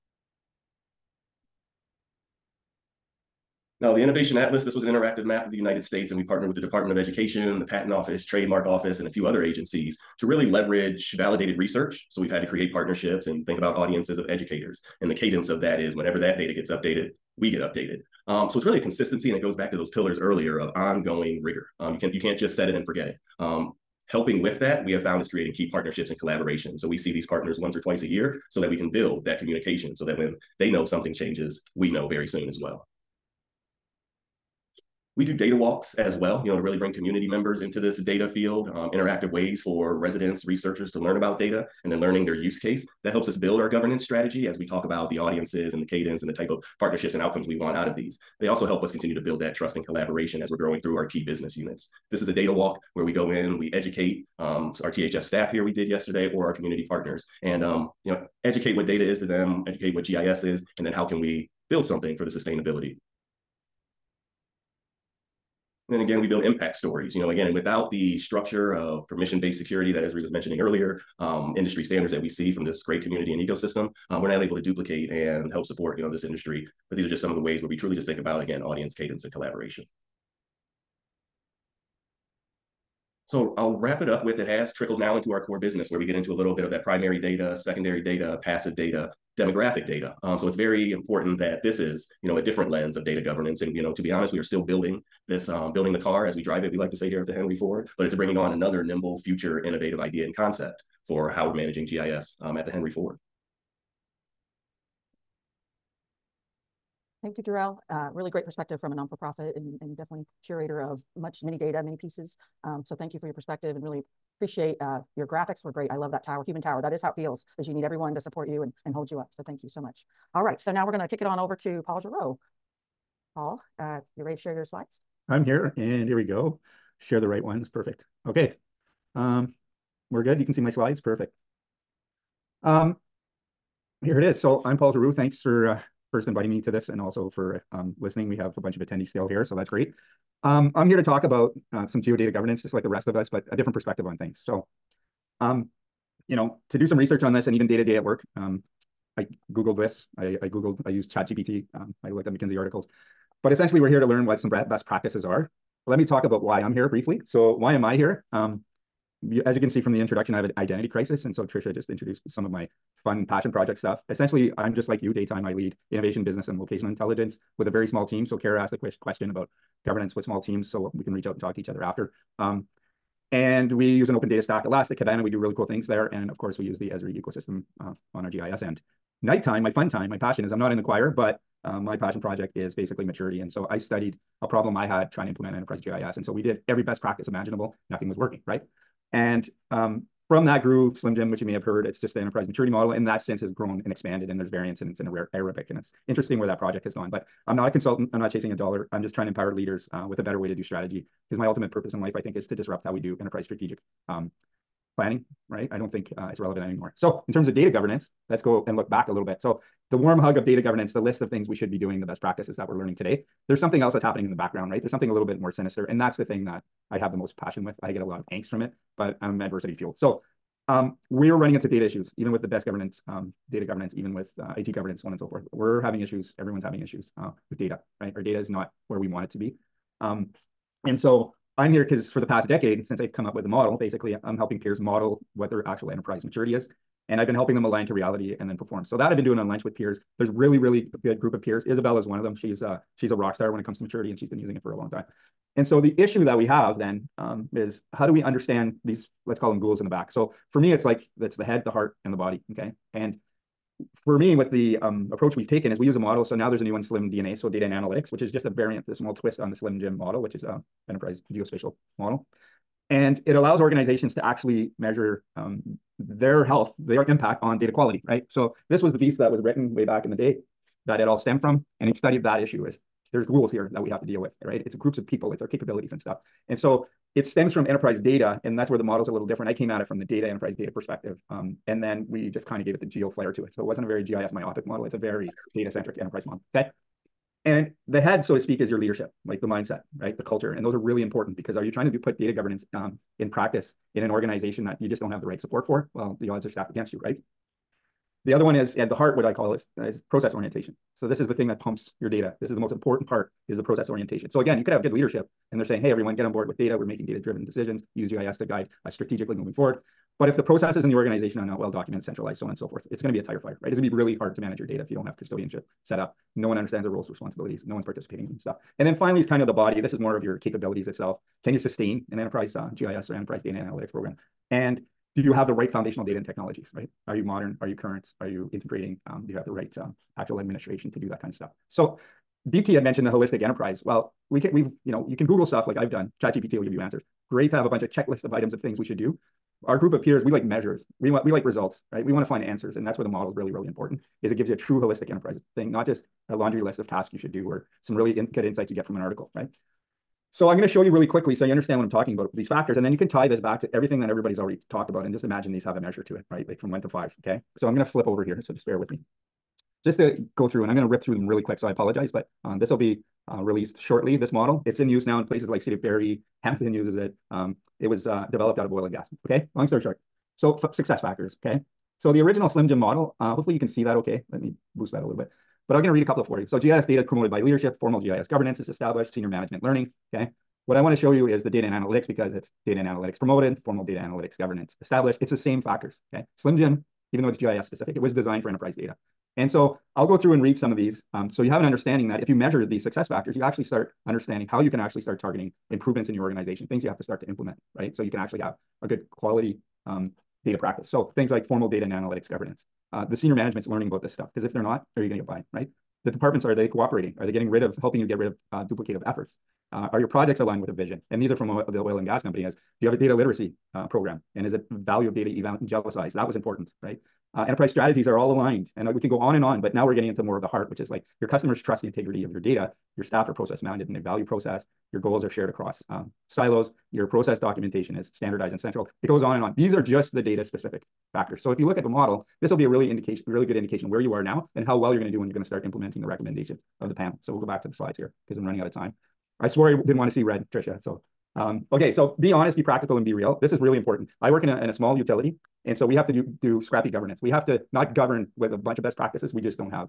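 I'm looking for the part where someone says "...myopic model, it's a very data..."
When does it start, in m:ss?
4:44.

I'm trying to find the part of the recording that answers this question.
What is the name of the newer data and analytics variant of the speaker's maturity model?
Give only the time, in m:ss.
4:16.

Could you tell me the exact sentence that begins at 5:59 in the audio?
Just to go through, and I'm going to rip through them really quick.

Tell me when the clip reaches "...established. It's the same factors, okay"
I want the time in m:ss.
6:24.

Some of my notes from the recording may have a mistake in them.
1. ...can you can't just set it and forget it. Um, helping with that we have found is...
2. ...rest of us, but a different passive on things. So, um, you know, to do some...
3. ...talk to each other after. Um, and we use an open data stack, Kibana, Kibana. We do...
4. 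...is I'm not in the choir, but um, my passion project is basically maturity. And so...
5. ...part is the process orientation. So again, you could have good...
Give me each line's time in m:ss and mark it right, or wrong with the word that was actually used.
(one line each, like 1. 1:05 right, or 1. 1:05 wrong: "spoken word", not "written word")
1. 0:21 right
2. 2:22 wrong: "perspective", not "passive"
3. 2:51 wrong: "Elastic", not "Kibana"
4. 3:00 right
5. 5:03 right.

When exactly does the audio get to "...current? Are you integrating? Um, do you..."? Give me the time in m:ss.
5:27.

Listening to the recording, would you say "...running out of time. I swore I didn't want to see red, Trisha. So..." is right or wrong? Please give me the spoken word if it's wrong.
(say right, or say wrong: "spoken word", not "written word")
right.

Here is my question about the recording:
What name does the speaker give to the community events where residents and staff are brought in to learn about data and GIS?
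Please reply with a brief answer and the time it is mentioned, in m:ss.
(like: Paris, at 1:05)
data walks, at 0:35.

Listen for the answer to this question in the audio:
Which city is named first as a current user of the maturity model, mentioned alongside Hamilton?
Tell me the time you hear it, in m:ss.
6:05.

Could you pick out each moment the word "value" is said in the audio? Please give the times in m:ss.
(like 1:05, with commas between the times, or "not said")
6:54, 7:03.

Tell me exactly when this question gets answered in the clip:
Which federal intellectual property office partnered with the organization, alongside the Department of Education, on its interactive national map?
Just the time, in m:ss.
0:07.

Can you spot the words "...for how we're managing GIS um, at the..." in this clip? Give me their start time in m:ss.
1:41.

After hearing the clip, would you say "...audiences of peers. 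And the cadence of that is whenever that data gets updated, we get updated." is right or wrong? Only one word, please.
wrong.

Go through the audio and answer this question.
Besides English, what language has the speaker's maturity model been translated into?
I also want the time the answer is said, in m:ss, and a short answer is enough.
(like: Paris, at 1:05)
Arabic, at 3:15.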